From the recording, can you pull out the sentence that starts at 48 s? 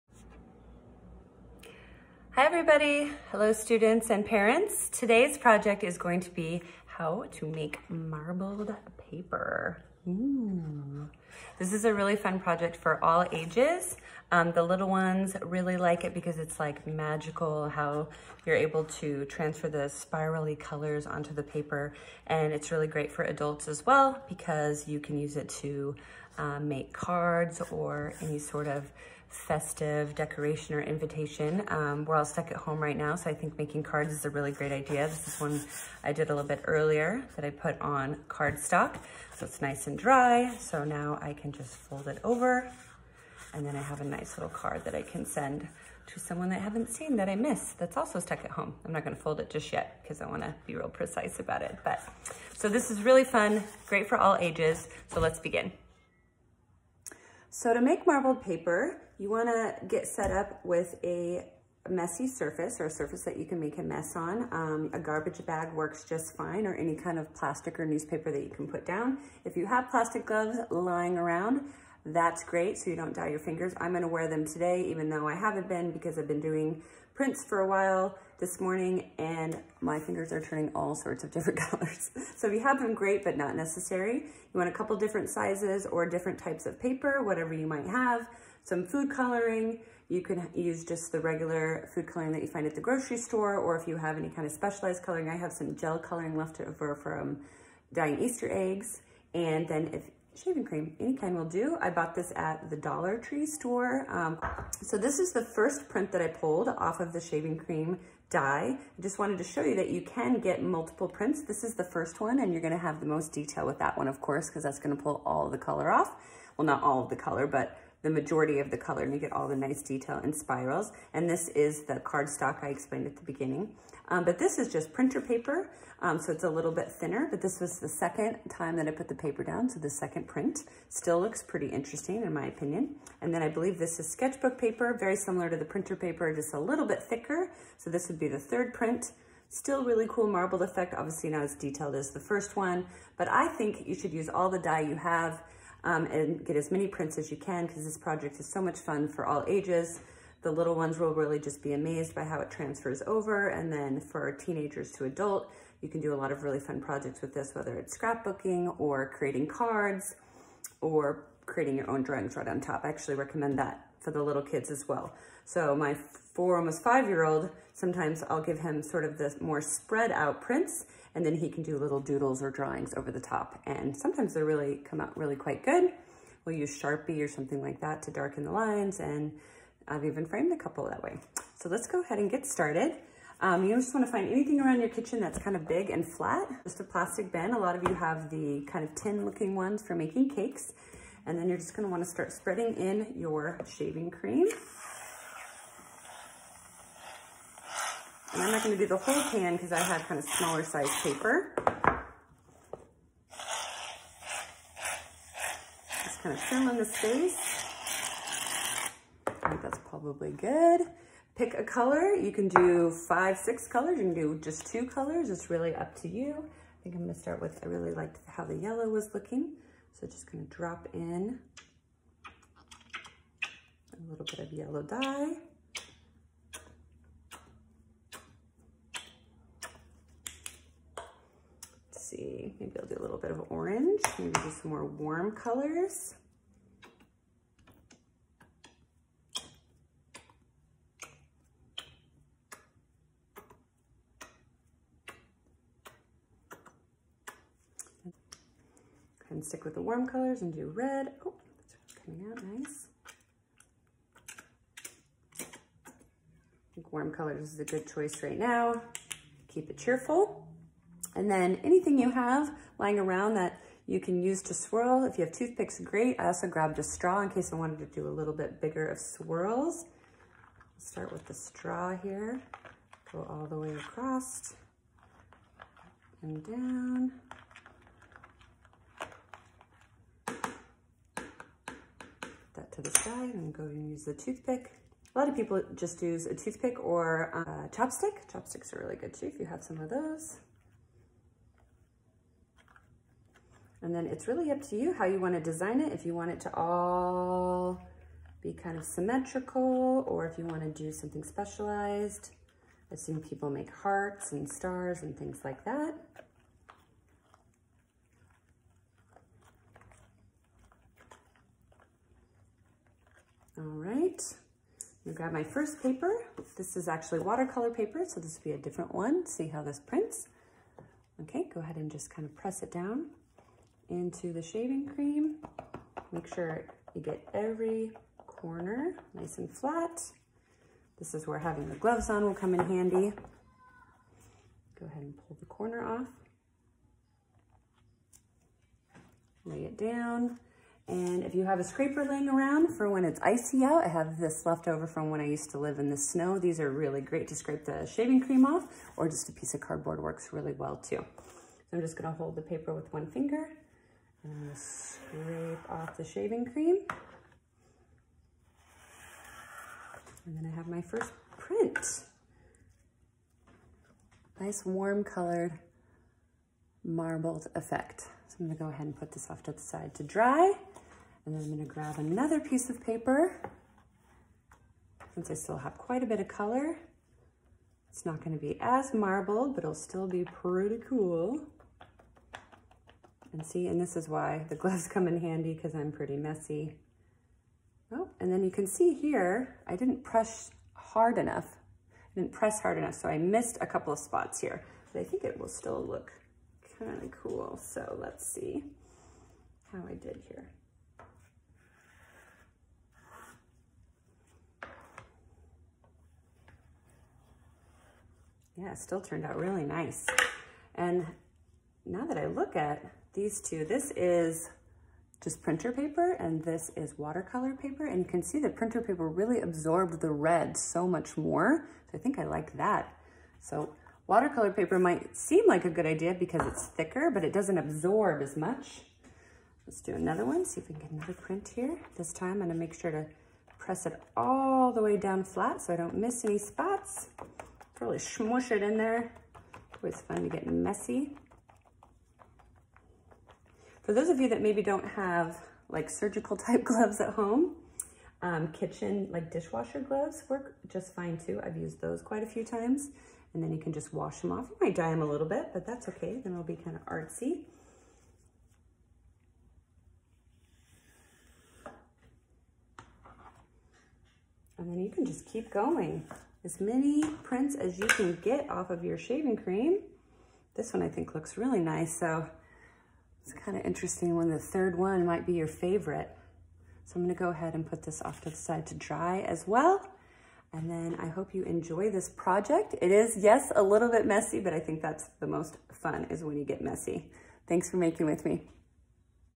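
I'm not gonna fold it just yet because I wanna be real precise about it.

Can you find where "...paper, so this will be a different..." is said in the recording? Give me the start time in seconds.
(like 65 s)
317 s.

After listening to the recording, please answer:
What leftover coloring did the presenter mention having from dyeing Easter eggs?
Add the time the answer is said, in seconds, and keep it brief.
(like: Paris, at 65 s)
gel coloring, at 95 s.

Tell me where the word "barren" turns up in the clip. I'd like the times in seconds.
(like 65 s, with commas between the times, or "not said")
not said.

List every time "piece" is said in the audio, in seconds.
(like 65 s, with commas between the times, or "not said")
349 s, 372 s.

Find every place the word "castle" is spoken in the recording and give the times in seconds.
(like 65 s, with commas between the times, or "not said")
not said.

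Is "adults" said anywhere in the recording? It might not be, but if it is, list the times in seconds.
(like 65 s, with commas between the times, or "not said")
23 s, 155 s.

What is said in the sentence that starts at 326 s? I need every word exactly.
Make sure you get every corner nice and flat.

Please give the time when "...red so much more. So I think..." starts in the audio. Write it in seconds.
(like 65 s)
420 s.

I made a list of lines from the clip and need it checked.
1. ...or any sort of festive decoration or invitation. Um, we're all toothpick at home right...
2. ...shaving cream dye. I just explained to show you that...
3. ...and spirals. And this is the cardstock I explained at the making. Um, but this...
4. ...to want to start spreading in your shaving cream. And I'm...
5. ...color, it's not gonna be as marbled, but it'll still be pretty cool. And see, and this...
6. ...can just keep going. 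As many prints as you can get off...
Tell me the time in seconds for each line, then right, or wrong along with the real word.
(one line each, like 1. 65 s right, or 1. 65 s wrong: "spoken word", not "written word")
1. 27 s wrong: "stuck", not "toothpick"
2. 107 s wrong: "wanted", not "explained"
3. 120 s wrong: "beginning", not "making"
4. 191 s right
5. 376 s right
6. 464 s right.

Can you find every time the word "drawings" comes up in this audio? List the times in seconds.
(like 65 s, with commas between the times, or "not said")
162 s, 172 s.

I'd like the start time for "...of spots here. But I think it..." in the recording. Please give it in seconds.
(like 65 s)
393 s.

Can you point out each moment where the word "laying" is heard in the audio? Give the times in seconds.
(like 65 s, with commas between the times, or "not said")
342 s.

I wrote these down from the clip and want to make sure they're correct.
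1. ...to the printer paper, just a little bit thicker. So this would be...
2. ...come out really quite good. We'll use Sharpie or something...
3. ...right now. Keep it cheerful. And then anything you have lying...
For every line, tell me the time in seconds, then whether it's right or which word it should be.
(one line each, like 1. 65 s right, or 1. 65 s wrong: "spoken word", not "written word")
1. 135 s right
2. 174 s right
3. 258 s right.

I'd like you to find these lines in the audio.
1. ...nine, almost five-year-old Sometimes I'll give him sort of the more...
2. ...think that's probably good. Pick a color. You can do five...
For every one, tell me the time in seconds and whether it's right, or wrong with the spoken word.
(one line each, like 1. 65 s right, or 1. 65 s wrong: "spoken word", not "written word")
1. 165 s wrong: "four", not "nine"
2. 209 s right.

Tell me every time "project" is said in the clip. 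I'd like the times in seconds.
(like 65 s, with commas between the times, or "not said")
5 s, 12 s, 147 s, 156 s, 482 s.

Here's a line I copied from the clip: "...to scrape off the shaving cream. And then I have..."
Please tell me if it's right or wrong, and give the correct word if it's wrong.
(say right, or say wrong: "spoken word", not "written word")
right.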